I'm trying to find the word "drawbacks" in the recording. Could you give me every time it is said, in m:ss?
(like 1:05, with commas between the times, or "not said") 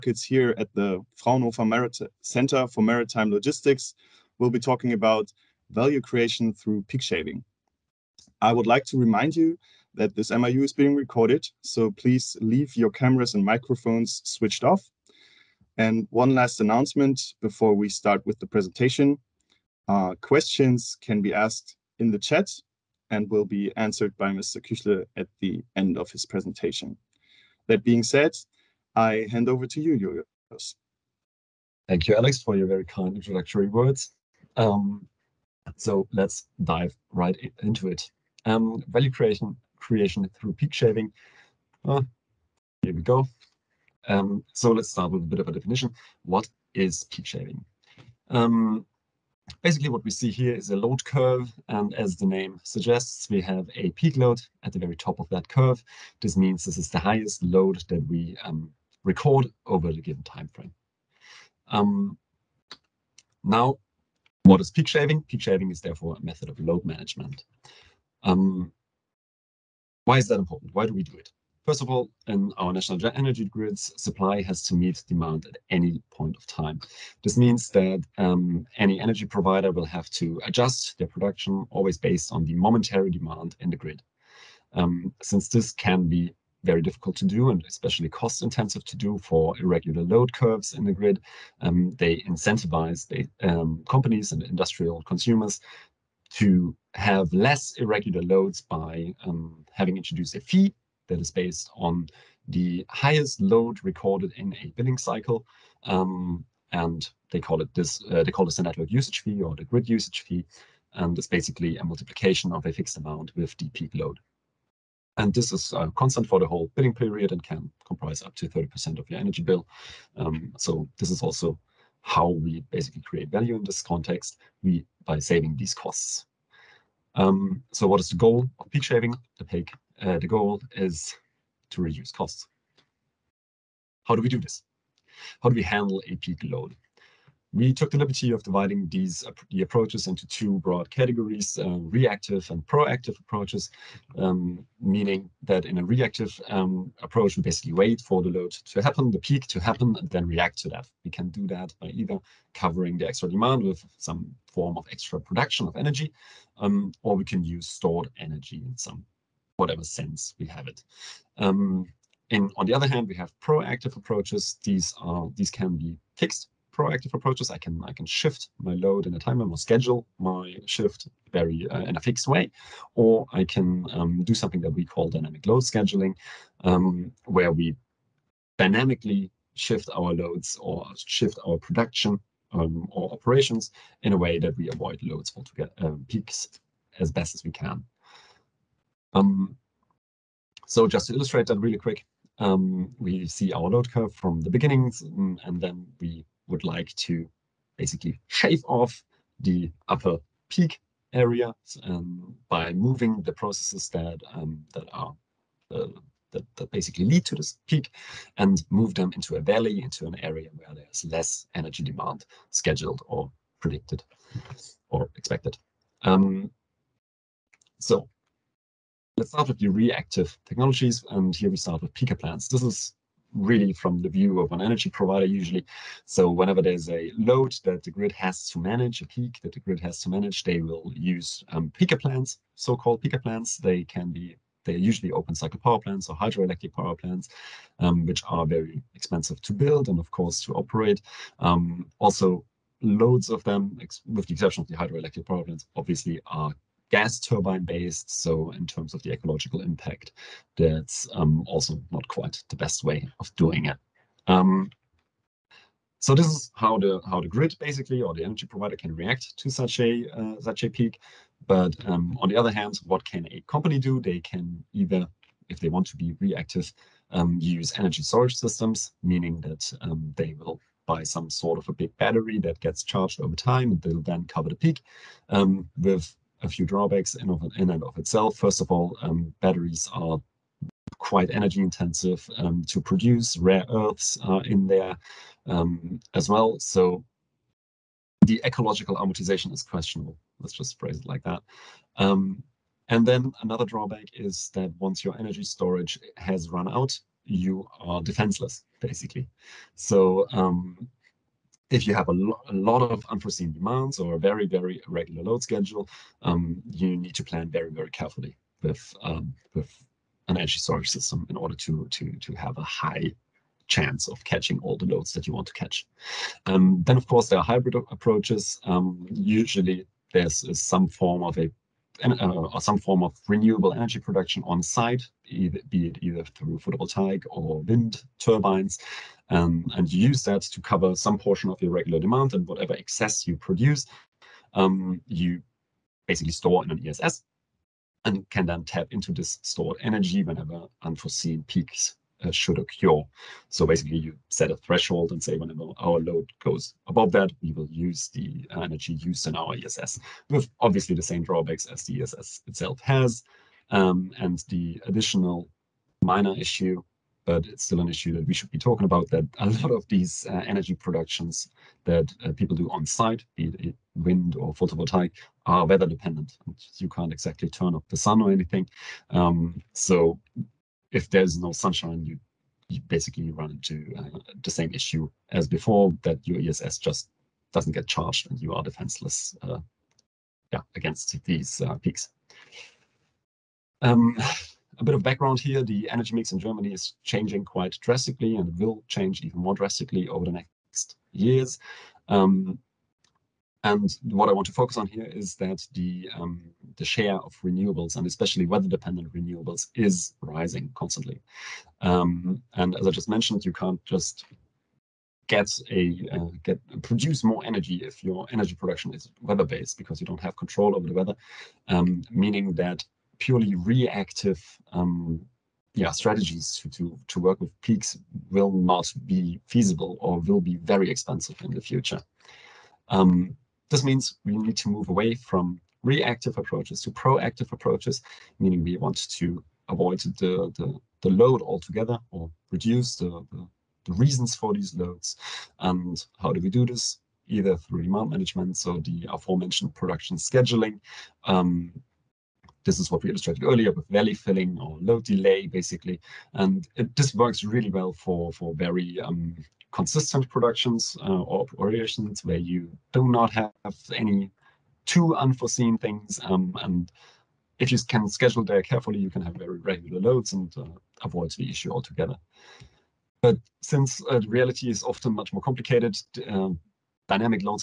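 4:36, 4:53, 5:51.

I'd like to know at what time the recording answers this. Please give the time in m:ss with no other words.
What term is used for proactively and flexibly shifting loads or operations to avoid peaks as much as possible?
2:55.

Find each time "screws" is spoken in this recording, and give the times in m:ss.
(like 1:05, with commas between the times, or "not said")
not said.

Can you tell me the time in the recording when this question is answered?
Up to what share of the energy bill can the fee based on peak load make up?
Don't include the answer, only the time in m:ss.
1:58.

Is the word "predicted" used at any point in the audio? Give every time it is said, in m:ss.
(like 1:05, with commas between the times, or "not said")
3:33.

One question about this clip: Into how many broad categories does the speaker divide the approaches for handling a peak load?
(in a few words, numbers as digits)
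2.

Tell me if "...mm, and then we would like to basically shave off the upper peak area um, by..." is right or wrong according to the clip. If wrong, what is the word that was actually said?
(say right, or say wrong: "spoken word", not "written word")
right.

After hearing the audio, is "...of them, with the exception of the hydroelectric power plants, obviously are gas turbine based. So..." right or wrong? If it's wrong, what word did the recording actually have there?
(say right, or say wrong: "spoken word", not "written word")
right.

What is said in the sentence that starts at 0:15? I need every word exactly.
And one last announcement before we start with the presentation.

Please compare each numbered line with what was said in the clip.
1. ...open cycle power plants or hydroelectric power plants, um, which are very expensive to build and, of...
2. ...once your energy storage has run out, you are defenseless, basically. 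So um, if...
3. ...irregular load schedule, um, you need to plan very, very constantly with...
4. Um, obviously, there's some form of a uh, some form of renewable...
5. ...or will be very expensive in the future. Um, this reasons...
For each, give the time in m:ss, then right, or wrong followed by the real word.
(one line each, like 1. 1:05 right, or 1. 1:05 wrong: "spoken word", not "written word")
1. 3:55 right
2. 4:54 right
3. 5:04 wrong: "carefully", not "constantly"
4. 5:18 wrong: "usually", not "obviously"
5. 6:59 wrong: "means", not "reasons".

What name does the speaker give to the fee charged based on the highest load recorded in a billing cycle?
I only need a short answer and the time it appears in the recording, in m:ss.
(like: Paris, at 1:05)
grid usage fee, at 1:49.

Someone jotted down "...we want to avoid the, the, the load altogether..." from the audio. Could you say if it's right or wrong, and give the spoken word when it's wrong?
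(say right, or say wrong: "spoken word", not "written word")
right.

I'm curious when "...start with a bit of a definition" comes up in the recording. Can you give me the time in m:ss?
0:44.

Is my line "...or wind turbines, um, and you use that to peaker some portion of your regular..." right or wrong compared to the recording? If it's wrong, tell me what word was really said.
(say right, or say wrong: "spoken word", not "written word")
wrong: "cover", not "peaker".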